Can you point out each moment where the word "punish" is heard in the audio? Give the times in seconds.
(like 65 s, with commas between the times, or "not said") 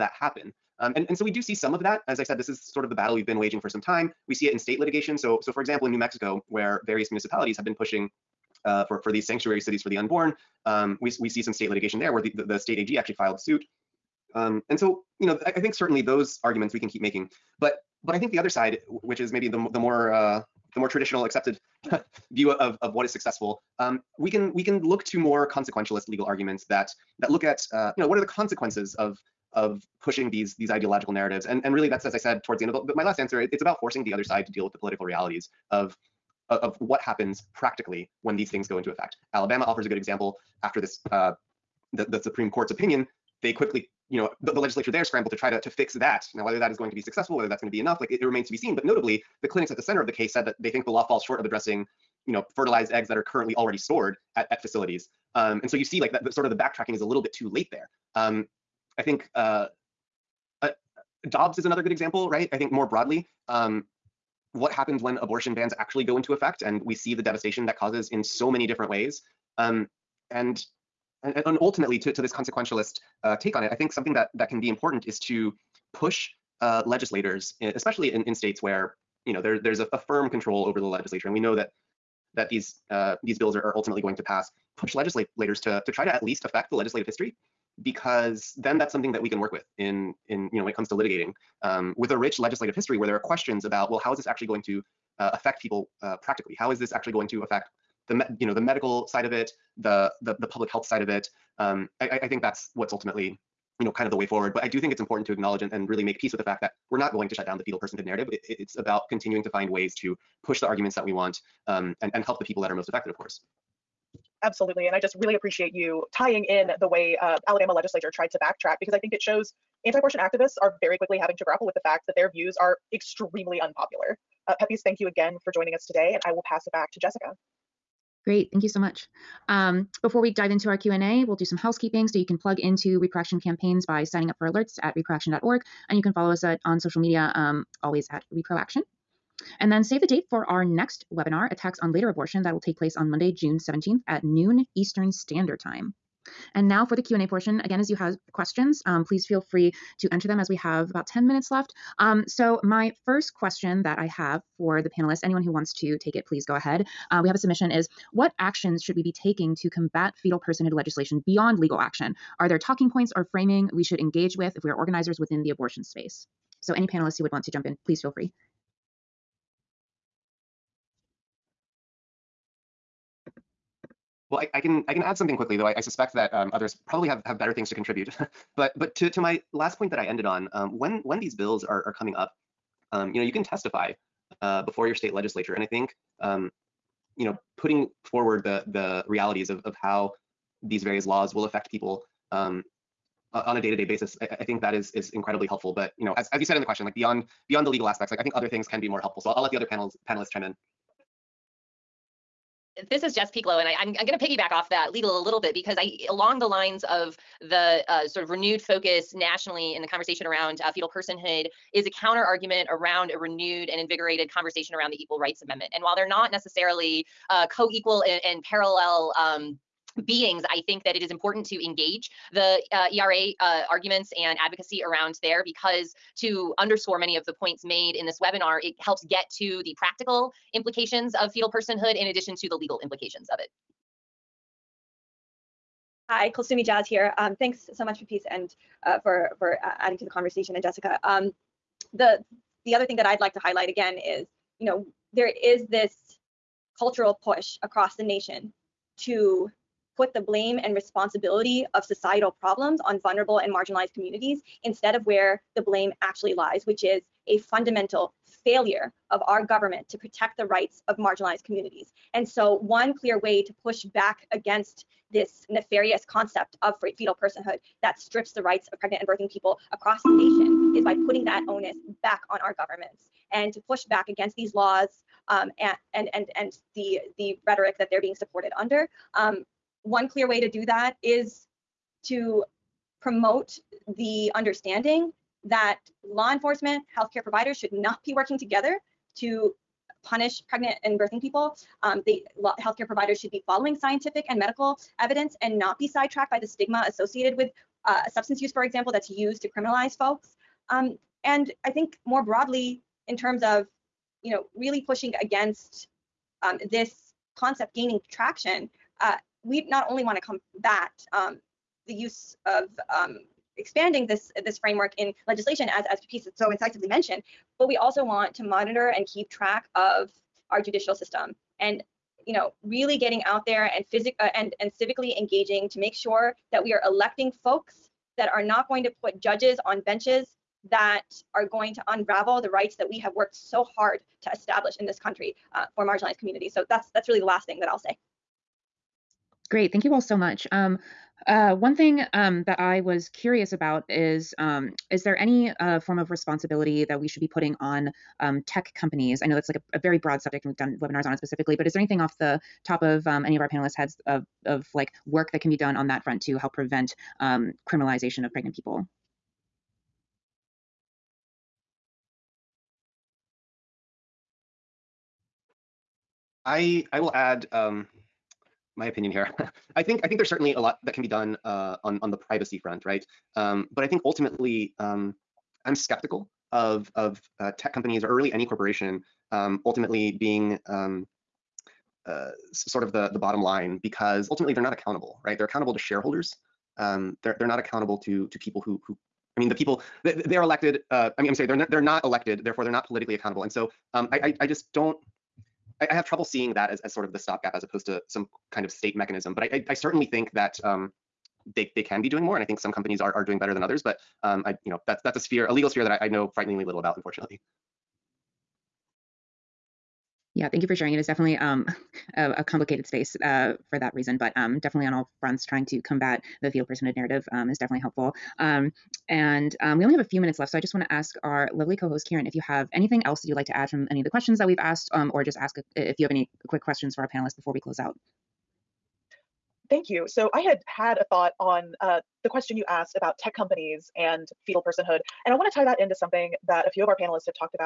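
290 s.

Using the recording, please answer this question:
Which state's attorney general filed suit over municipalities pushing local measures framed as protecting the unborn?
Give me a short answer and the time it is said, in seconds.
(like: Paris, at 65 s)
New Mexico, at 5 s.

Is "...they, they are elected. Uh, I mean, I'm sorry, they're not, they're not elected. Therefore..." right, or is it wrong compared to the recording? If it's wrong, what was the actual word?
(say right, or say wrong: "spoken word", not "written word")
right.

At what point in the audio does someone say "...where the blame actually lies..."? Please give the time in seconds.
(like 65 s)
255 s.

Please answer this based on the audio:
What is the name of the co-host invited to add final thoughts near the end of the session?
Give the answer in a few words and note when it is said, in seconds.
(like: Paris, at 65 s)
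Karen, at 422 s.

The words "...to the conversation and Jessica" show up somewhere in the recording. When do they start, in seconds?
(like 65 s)
239 s.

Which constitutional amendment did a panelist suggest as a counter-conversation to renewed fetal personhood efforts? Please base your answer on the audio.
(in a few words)
Equal Rights Amendment.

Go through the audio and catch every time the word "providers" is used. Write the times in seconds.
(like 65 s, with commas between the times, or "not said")
287 s, 292 s.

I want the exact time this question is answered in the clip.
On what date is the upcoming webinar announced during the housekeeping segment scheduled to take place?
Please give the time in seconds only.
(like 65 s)
143 s.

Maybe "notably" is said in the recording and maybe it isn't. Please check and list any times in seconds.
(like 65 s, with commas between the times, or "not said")
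48 s.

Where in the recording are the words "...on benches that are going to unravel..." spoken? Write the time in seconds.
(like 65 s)
329 s.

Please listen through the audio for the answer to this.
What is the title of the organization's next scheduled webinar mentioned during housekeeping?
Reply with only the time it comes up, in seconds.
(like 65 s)
141 s.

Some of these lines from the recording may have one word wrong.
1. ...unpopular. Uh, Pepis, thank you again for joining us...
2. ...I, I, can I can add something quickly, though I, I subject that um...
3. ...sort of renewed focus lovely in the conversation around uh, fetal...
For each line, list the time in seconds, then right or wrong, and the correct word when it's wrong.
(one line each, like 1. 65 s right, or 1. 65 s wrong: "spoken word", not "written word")
1. 123 s right
2. 174 s wrong: "suspect", not "subject"
3. 208 s wrong: "nationally", not "lovely".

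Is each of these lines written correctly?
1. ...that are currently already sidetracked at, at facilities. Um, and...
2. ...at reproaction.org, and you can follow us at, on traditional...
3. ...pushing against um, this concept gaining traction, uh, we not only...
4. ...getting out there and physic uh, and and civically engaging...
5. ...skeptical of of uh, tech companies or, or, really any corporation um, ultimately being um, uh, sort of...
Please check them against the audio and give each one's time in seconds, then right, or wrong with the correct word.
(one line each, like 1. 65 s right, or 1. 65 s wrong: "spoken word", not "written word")
1. 53 s wrong: "stored", not "sidetracked"
2. 134 s wrong: "social", not "traditional"
3. 304 s right
4. 322 s right
5. 375 s right.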